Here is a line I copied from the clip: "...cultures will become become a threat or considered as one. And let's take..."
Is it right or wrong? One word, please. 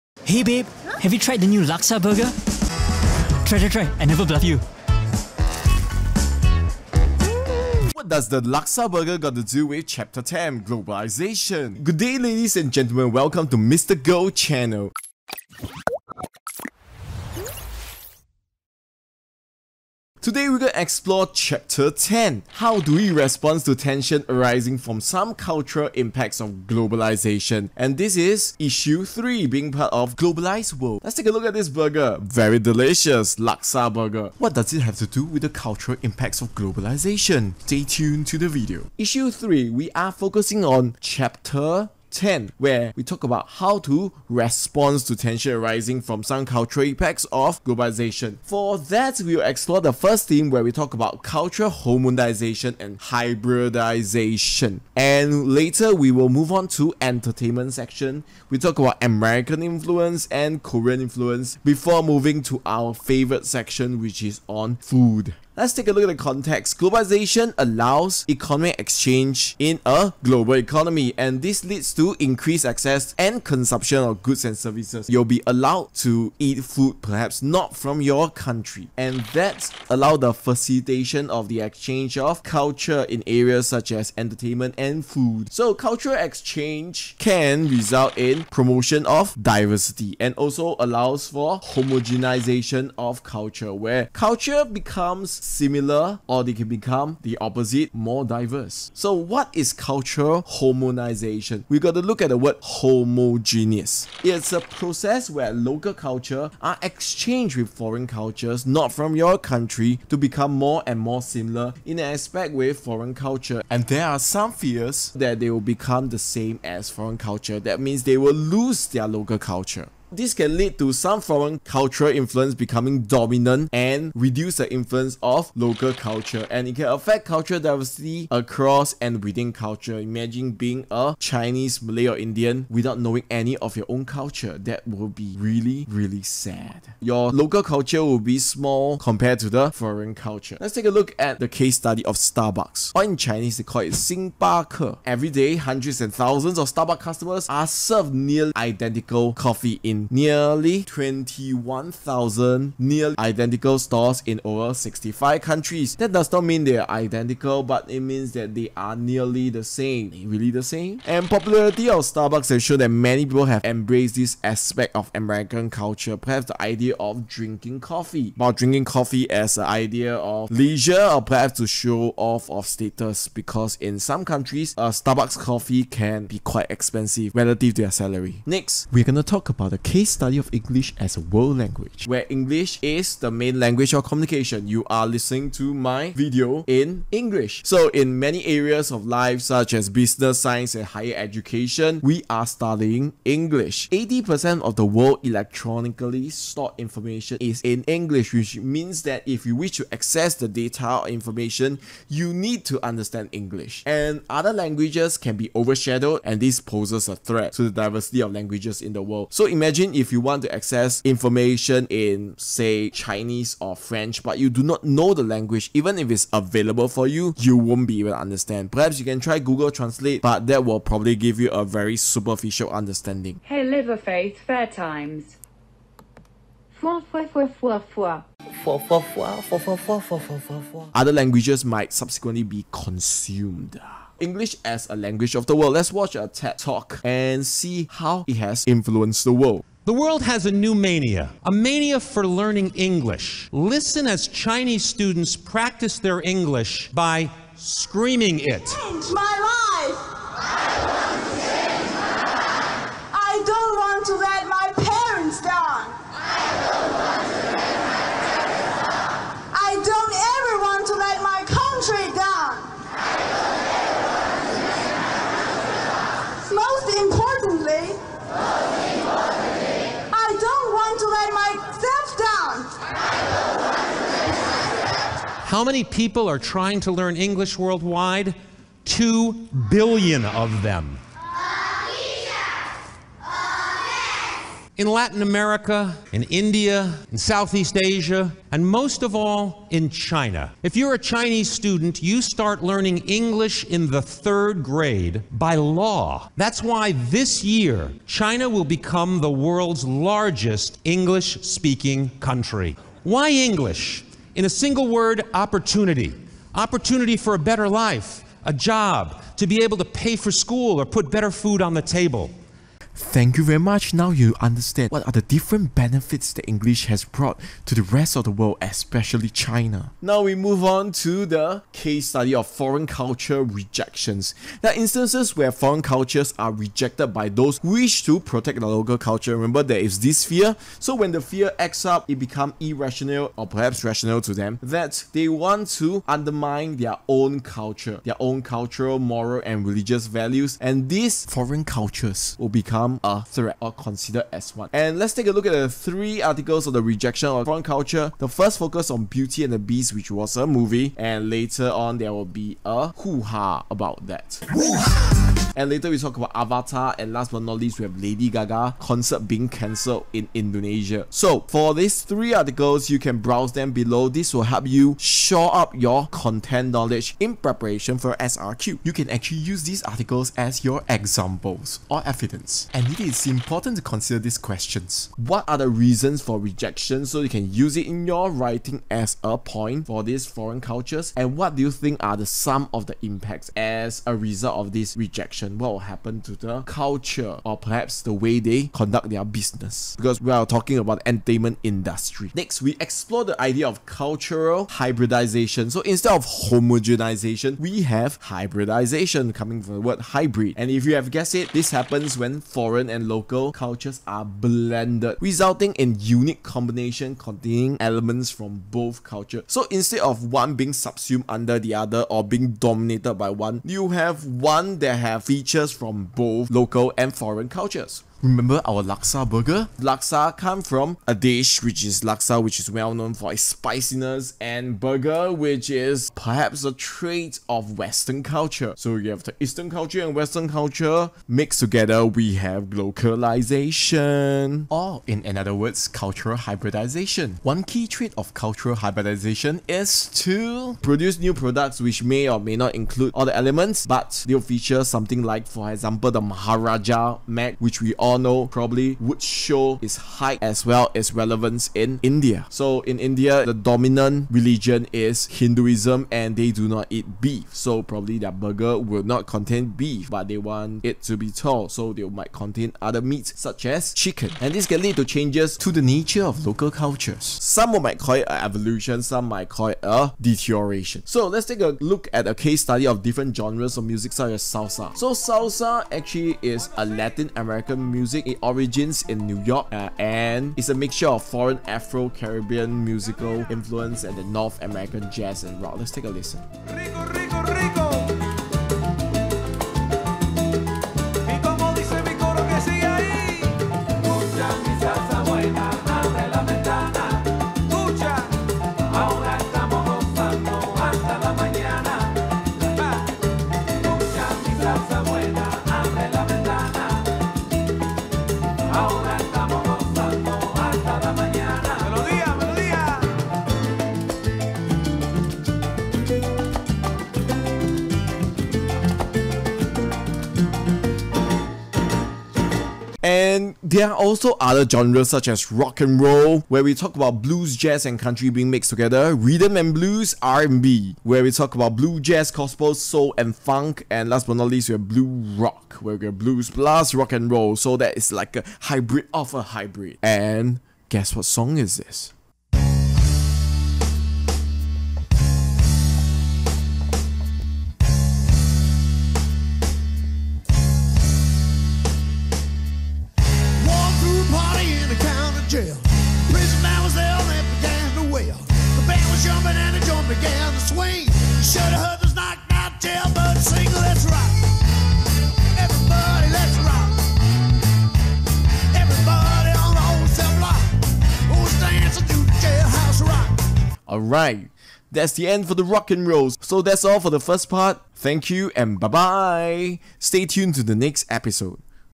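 right.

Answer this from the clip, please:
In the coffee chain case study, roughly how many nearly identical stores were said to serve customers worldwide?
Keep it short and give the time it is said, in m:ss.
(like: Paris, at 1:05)
21,000, at 2:30.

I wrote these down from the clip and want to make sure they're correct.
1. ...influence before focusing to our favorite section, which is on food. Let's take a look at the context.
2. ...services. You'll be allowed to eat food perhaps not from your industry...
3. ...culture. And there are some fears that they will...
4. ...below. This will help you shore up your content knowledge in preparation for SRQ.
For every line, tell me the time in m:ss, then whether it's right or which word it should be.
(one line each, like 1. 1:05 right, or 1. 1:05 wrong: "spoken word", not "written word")
1. 1:01 wrong: "moving", not "focusing"
2. 1:14 wrong: "country", not "industry"
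3. 1:53 right
4. 6:03 right.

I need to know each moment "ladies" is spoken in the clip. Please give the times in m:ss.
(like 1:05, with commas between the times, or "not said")
0:12.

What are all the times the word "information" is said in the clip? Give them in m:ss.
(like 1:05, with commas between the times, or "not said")
3:16, 3:21, 3:31.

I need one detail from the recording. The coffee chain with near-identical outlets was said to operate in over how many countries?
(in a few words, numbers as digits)
65.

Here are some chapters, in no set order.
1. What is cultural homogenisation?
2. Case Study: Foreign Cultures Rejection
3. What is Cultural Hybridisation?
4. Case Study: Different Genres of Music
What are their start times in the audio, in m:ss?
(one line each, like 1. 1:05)
1. 1:38
2. 5:13
3. 6:32
4. 7:51.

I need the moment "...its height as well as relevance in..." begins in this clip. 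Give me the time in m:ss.
7:29.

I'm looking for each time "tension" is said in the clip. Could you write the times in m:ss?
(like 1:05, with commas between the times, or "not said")
0:23, 0:45.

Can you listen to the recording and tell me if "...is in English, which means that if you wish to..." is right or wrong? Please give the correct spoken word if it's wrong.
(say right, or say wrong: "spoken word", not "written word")
right.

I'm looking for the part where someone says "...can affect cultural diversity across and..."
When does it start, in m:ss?
2:06.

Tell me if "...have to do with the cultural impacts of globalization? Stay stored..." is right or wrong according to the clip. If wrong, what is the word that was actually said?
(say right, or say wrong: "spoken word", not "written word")
wrong: "tuned", not "stored".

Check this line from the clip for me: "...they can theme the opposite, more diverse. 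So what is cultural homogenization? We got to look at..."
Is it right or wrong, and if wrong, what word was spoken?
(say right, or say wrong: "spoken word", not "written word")
wrong: "become", not "theme".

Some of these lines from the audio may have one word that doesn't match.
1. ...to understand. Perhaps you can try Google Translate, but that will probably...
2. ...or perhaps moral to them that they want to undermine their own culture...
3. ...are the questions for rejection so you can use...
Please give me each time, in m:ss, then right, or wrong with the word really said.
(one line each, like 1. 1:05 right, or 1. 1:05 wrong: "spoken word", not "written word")
1. 3:38 right
2. 5:33 wrong: "rational", not "moral"
3. 6:15 wrong: "reasons", not "questions".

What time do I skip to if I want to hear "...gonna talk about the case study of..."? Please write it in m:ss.
2:59.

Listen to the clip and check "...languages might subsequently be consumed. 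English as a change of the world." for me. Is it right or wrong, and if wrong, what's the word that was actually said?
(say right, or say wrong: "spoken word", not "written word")
wrong: "language", not "change".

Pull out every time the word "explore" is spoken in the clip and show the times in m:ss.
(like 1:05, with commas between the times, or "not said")
0:20, 0:49, 6:32.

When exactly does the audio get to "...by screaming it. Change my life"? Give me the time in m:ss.
4:06.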